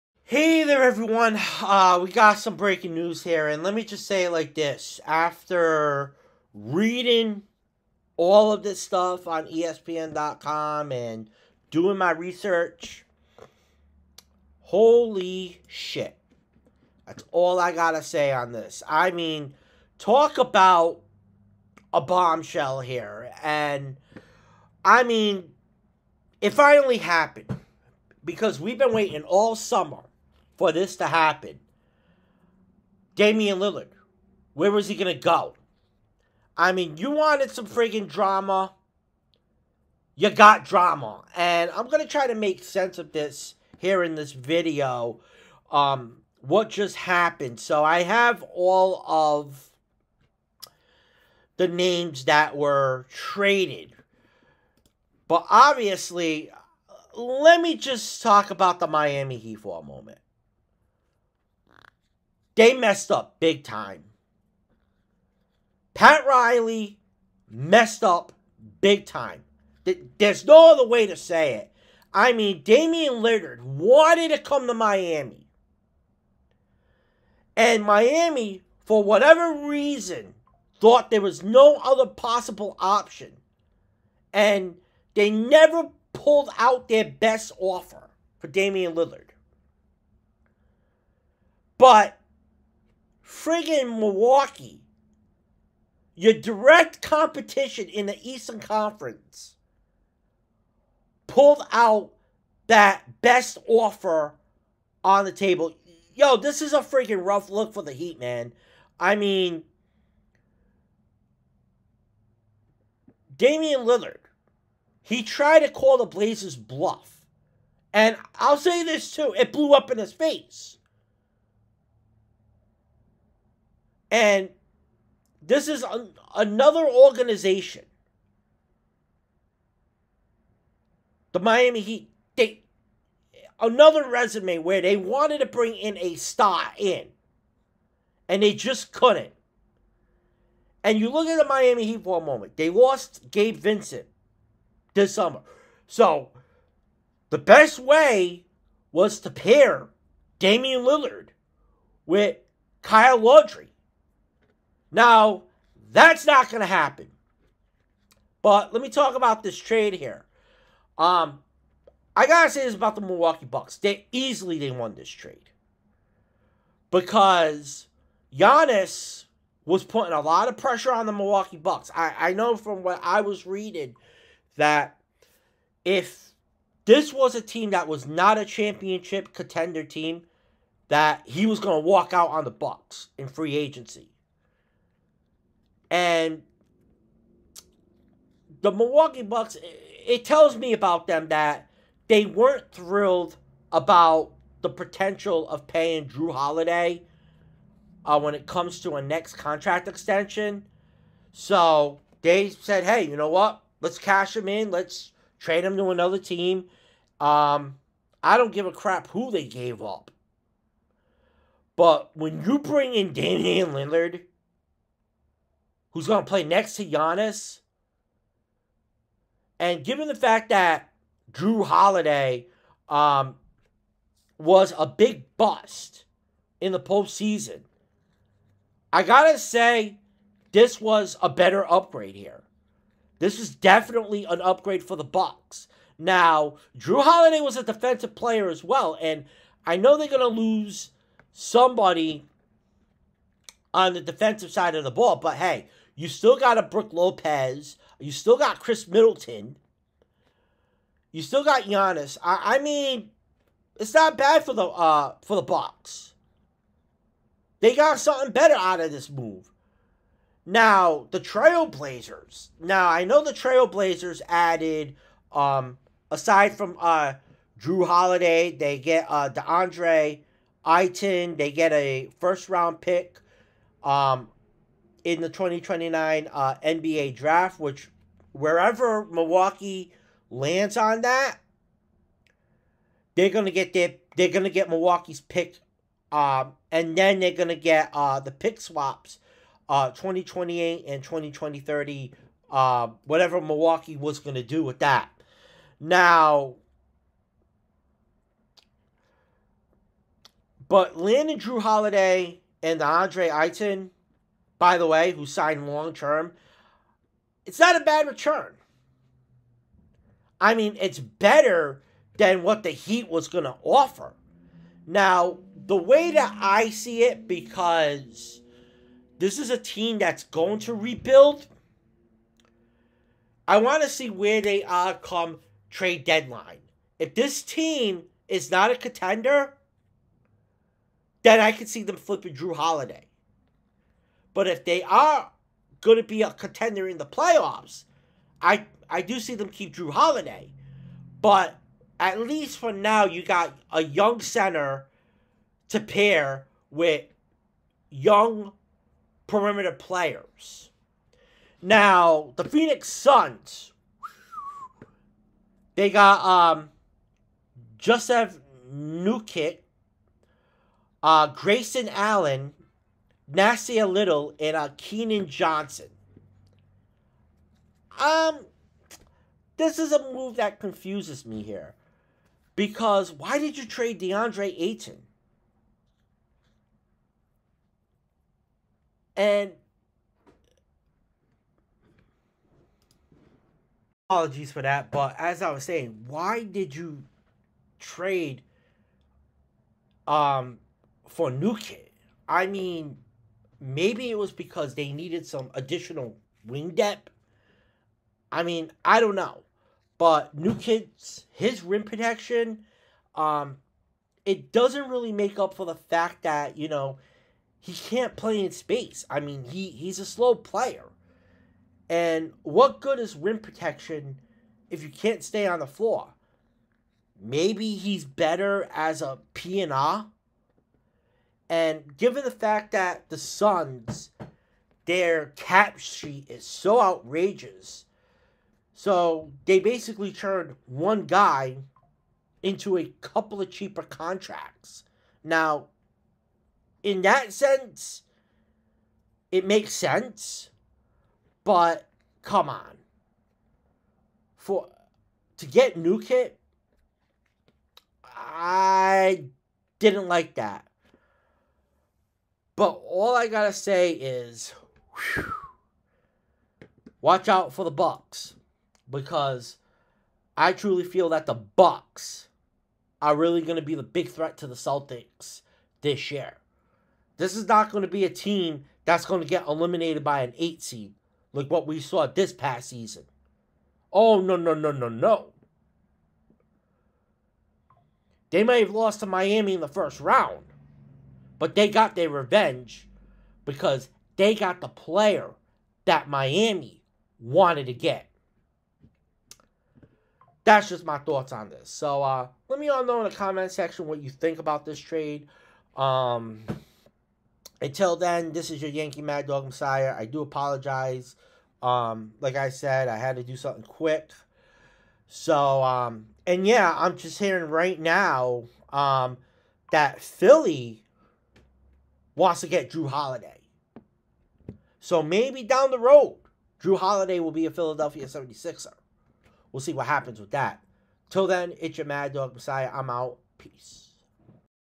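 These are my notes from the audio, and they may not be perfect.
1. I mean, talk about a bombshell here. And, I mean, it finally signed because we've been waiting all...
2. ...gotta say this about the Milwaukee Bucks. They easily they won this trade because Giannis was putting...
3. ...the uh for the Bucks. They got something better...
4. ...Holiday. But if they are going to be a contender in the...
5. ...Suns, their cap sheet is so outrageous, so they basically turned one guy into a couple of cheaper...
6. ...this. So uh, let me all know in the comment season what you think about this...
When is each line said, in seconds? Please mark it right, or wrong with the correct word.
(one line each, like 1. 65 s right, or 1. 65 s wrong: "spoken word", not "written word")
1. 18 s wrong: "happened", not "signed"
2. 162 s right
3. 254 s right
4. 332 s right
5. 423 s right
6. 491 s wrong: "section", not "season".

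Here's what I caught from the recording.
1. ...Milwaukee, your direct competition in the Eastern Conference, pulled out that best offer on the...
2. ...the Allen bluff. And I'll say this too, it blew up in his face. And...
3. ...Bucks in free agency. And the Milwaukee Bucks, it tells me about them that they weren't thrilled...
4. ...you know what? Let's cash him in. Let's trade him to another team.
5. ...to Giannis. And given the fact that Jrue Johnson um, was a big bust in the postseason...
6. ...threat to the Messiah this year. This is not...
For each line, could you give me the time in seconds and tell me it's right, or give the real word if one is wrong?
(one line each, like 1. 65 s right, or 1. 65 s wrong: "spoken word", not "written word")
1. 93 s right
2. 115 s wrong: "Blazers", not "Allen"
3. 182 s right
4. 203 s right
5. 216 s wrong: "Holiday", not "Johnson"
6. 464 s wrong: "Celtics", not "Messiah".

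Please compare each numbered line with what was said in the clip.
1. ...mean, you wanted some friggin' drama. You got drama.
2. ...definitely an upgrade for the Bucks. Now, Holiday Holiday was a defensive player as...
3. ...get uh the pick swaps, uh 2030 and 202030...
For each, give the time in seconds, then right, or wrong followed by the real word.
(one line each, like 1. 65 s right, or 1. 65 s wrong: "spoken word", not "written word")
1. 36 s right
2. 233 s wrong: "Jrue", not "Holiday"
3. 287 s wrong: "2028", not "2030".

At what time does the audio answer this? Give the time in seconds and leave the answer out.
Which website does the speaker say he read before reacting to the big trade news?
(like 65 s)
9 s.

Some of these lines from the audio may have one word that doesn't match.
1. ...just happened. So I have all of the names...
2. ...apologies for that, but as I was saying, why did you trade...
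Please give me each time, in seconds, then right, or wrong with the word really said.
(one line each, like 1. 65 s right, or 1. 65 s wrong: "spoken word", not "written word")
1. 46 s right
2. 384 s right.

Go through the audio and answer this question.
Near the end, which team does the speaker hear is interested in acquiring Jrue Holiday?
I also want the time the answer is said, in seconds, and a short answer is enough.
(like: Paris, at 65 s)
Philadelphia 76ers, at 510 s.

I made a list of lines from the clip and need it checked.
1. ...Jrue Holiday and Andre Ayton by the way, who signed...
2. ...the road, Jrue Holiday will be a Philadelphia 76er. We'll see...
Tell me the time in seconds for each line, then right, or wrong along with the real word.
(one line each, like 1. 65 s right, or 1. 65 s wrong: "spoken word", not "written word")
1. 301 s right
2. 515 s right.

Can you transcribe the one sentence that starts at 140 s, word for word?
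And you look at the Miami Heat for a moment.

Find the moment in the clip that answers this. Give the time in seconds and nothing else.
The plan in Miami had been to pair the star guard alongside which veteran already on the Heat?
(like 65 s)
152 s.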